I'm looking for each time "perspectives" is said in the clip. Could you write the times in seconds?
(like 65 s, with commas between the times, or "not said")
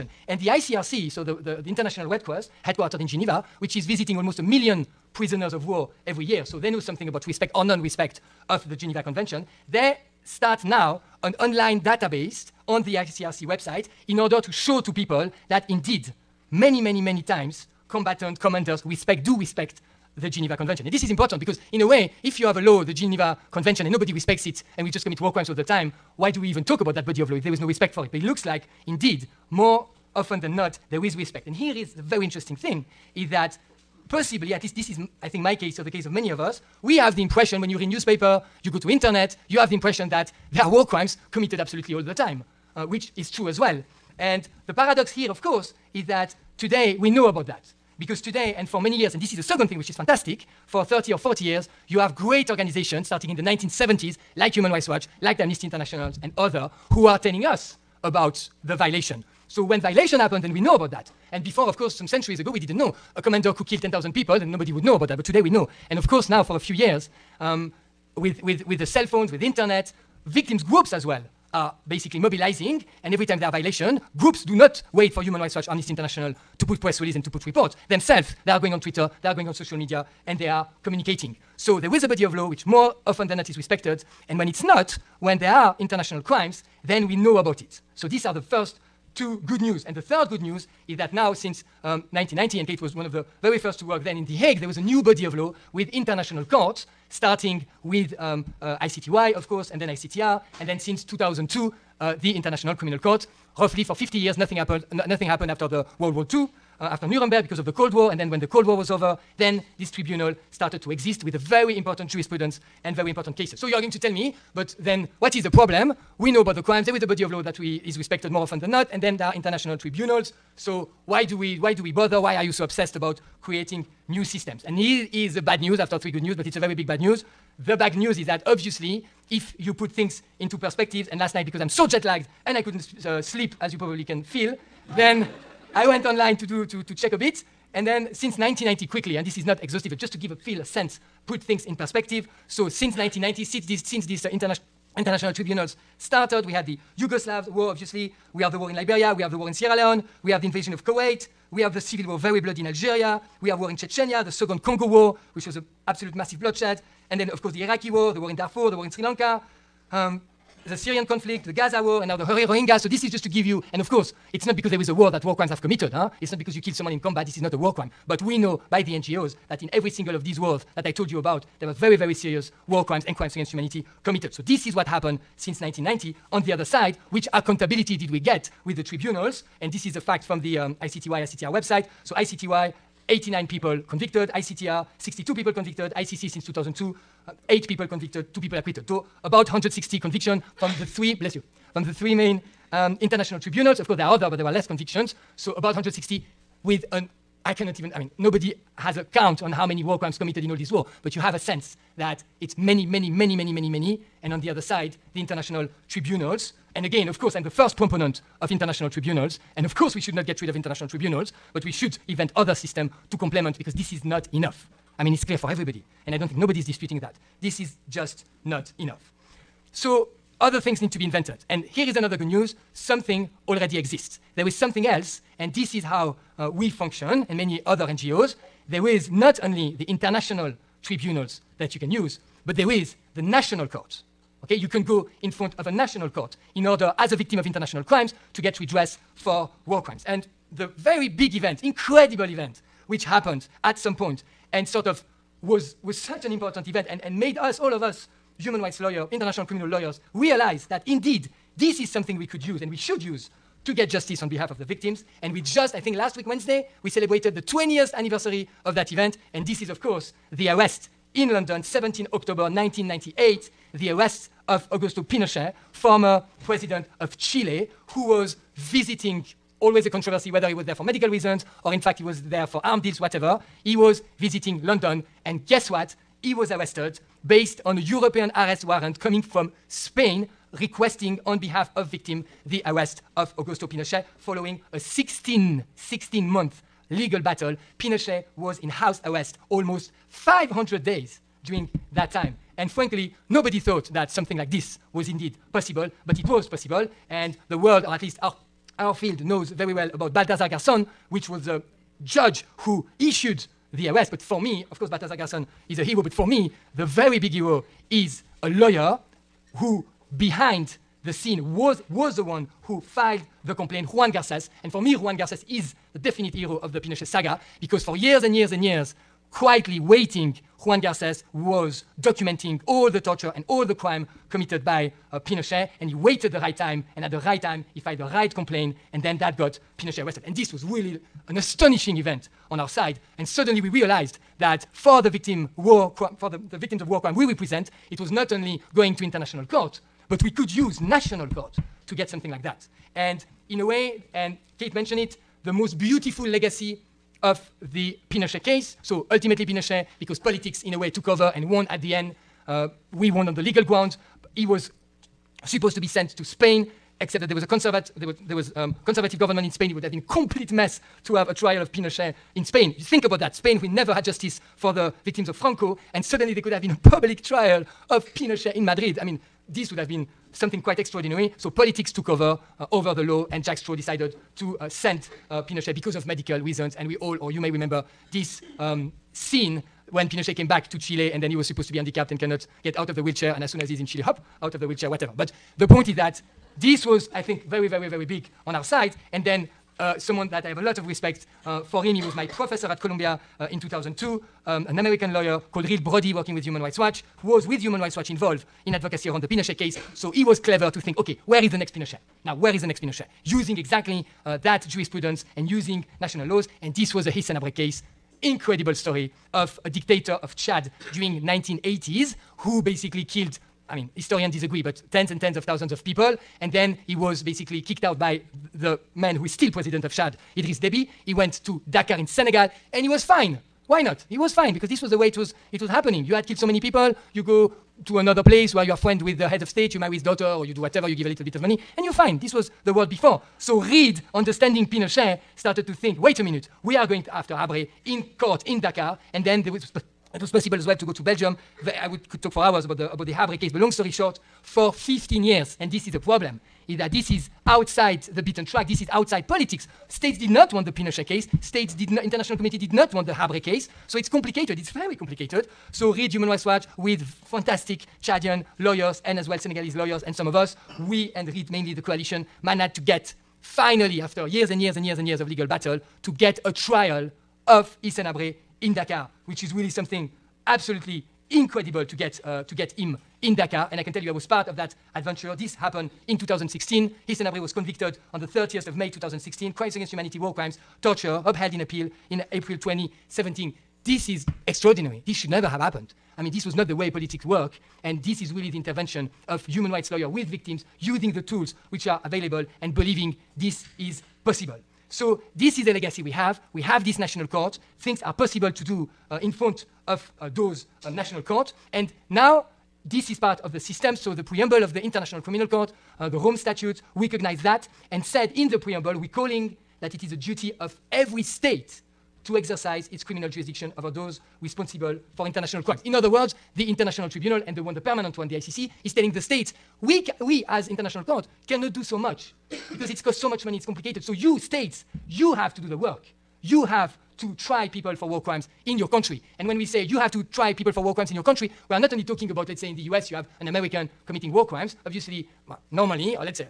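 130 s, 141 s.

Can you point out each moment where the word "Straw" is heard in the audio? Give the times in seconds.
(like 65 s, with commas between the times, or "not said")
373 s.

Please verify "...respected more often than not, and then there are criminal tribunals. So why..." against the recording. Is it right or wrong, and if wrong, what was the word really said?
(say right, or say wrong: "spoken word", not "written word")
wrong: "international", not "criminal".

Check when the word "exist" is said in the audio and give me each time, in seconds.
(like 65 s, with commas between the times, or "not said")
110 s, 223 s.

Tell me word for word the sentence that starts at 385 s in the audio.
But the point is that this was, I think, very, very, very big on our side.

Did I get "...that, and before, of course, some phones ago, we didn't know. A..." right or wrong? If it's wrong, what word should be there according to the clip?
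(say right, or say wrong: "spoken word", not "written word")
wrong: "centuries", not "phones".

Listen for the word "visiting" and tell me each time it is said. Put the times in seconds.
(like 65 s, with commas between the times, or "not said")
3 s, 268 s, 274 s.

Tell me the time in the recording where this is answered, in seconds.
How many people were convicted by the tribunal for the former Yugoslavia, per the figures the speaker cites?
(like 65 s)
183 s.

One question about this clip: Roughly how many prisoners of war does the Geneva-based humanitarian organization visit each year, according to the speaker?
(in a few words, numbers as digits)
almost a million.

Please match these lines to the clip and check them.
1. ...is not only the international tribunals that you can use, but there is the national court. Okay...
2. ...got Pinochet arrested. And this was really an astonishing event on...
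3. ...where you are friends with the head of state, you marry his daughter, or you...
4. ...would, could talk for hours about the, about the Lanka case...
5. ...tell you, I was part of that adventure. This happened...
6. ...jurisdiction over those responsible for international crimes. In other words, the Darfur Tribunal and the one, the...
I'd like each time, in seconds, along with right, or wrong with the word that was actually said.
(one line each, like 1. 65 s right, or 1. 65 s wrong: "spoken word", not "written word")
1. 228 s right
2. 329 s right
3. 428 s right
4. 441 s wrong: "Habre", not "Lanka"
5. 473 s right
6. 513 s wrong: "International", not "Darfur".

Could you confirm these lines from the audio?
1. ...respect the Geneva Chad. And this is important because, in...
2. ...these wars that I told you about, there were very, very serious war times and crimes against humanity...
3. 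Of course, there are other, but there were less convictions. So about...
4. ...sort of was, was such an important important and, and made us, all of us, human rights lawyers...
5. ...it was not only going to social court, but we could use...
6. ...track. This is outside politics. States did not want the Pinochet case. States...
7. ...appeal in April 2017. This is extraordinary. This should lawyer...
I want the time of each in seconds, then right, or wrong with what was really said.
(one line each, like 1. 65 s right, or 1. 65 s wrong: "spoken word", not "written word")
1. 19 s wrong: "Convention", not "Chad"
2. 170 s wrong: "crimes", not "times"
3. 193 s right
4. 244 s wrong: "event", not "important"
5. 337 s wrong: "international", not "social"
6. 448 s right
7. 481 s wrong: "never", not "lawyer".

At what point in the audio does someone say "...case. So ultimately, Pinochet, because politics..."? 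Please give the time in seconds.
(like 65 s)
348 s.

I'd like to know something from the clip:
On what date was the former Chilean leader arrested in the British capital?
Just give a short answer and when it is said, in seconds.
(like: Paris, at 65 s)
17 October 1998, at 261 s.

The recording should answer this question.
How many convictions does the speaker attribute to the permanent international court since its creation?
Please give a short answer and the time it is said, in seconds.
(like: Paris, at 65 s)
8, at 187 s.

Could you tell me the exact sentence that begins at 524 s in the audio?
So you states you have to do the work.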